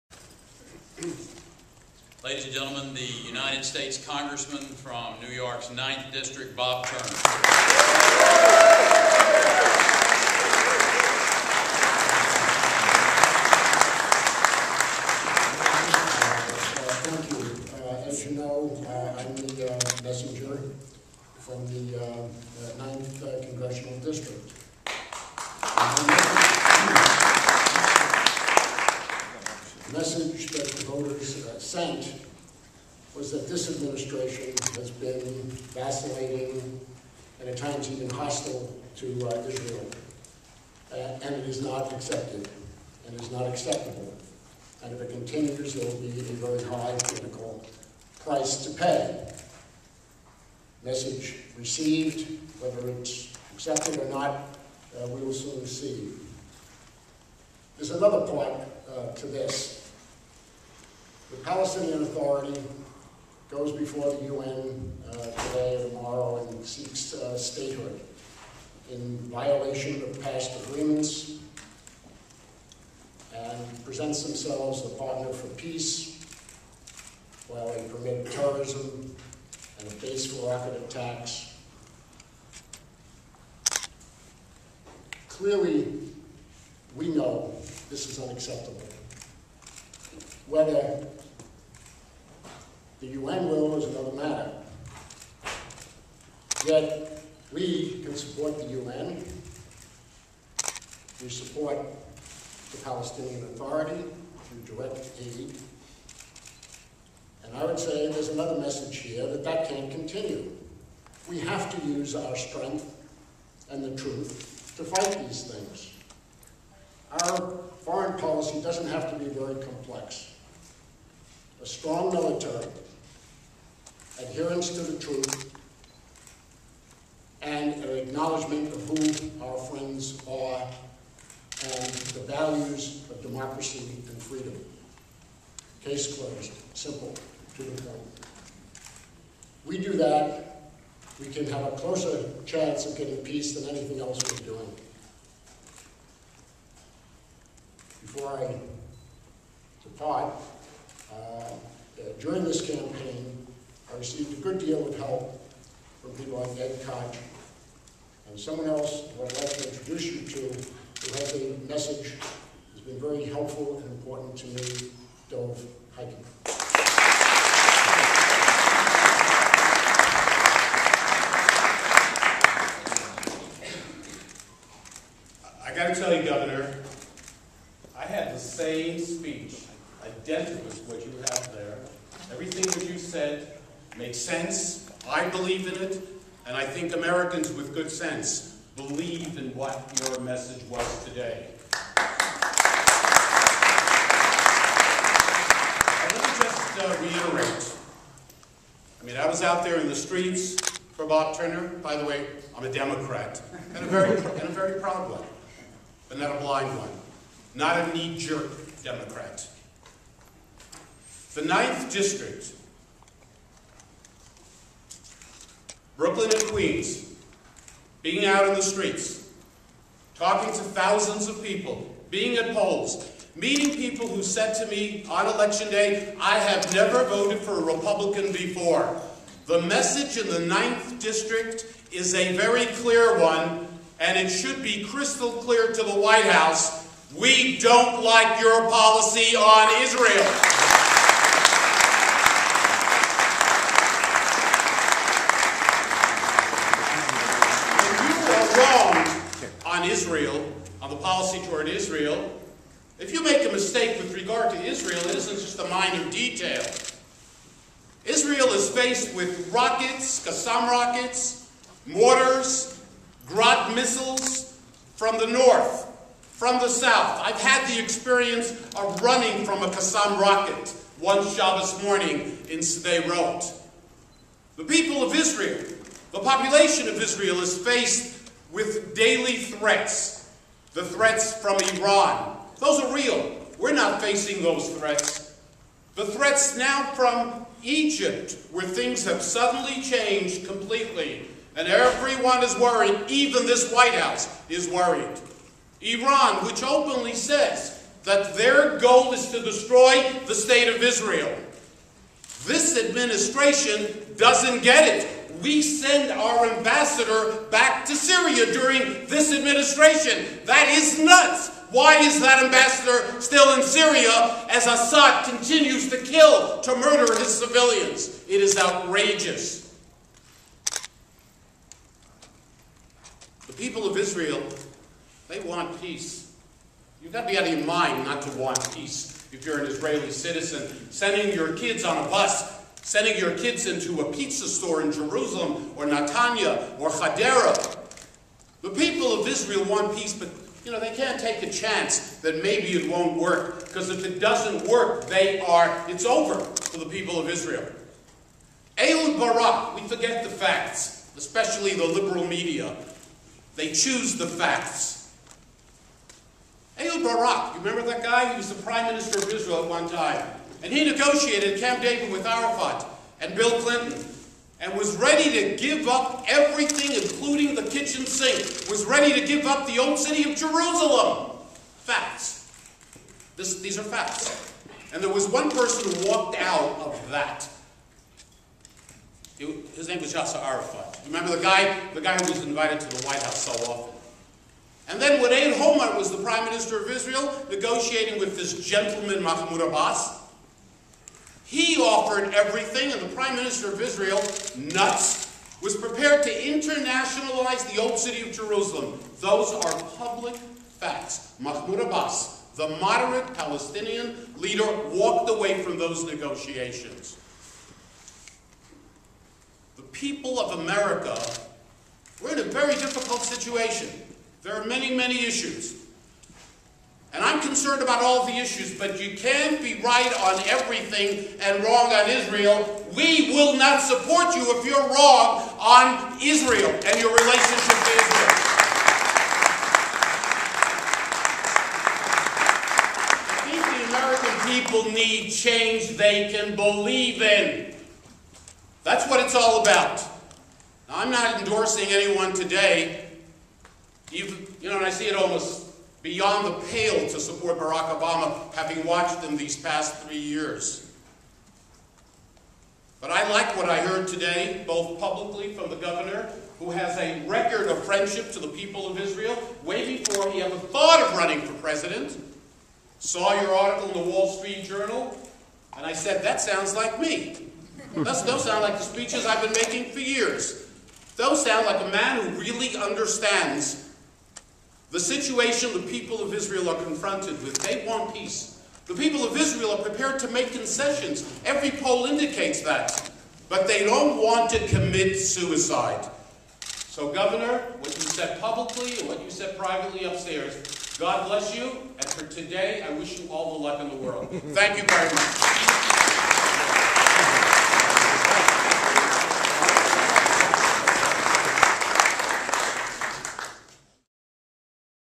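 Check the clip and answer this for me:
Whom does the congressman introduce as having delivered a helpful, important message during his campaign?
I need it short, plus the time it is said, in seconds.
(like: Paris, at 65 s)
Dov Hikind, at 165 s.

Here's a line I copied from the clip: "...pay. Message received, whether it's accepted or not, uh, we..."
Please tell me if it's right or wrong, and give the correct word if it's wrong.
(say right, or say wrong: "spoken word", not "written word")
right.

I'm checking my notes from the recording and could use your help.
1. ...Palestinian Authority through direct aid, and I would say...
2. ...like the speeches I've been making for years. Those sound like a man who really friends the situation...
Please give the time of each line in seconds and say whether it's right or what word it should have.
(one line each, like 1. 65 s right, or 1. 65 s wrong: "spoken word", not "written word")
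1. 102 s right
2. 468 s wrong: "understands", not "friends".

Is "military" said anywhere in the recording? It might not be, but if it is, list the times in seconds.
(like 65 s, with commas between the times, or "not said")
122 s.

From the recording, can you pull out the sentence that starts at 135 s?
Case closed, simple, to the point.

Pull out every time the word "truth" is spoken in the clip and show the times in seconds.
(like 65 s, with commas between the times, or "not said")
113 s, 124 s.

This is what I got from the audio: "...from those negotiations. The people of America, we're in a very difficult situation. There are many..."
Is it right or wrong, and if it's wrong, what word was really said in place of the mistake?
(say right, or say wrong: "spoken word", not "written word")
right.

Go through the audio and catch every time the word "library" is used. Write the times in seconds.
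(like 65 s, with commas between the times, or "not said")
not said.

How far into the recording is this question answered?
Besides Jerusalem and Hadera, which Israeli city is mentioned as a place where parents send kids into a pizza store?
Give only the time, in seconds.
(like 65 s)
335 s.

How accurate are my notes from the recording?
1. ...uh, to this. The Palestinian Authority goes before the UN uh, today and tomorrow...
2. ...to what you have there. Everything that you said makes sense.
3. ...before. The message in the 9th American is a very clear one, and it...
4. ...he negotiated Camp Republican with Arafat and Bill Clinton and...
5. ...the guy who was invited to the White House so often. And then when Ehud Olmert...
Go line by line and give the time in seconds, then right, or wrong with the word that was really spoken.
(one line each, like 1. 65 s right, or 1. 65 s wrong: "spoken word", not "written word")
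1. 58 s right
2. 180 s right
3. 228 s wrong: "District", not "American"
4. 360 s wrong: "David", not "Republican"
5. 381 s right.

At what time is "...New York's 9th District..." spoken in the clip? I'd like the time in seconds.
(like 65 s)
5 s.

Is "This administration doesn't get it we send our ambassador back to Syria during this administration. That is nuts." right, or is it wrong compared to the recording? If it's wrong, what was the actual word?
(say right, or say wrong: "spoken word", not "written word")
right.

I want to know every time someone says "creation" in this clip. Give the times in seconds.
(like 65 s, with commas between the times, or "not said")
not said.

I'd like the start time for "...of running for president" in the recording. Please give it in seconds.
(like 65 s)
461 s.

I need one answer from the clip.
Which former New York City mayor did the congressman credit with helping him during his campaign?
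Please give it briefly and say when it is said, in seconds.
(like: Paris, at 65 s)
Ed Koch, at 156 s.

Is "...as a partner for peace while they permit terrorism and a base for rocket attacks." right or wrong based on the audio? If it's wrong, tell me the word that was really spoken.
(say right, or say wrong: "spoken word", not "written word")
right.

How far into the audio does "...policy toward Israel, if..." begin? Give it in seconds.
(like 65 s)
250 s.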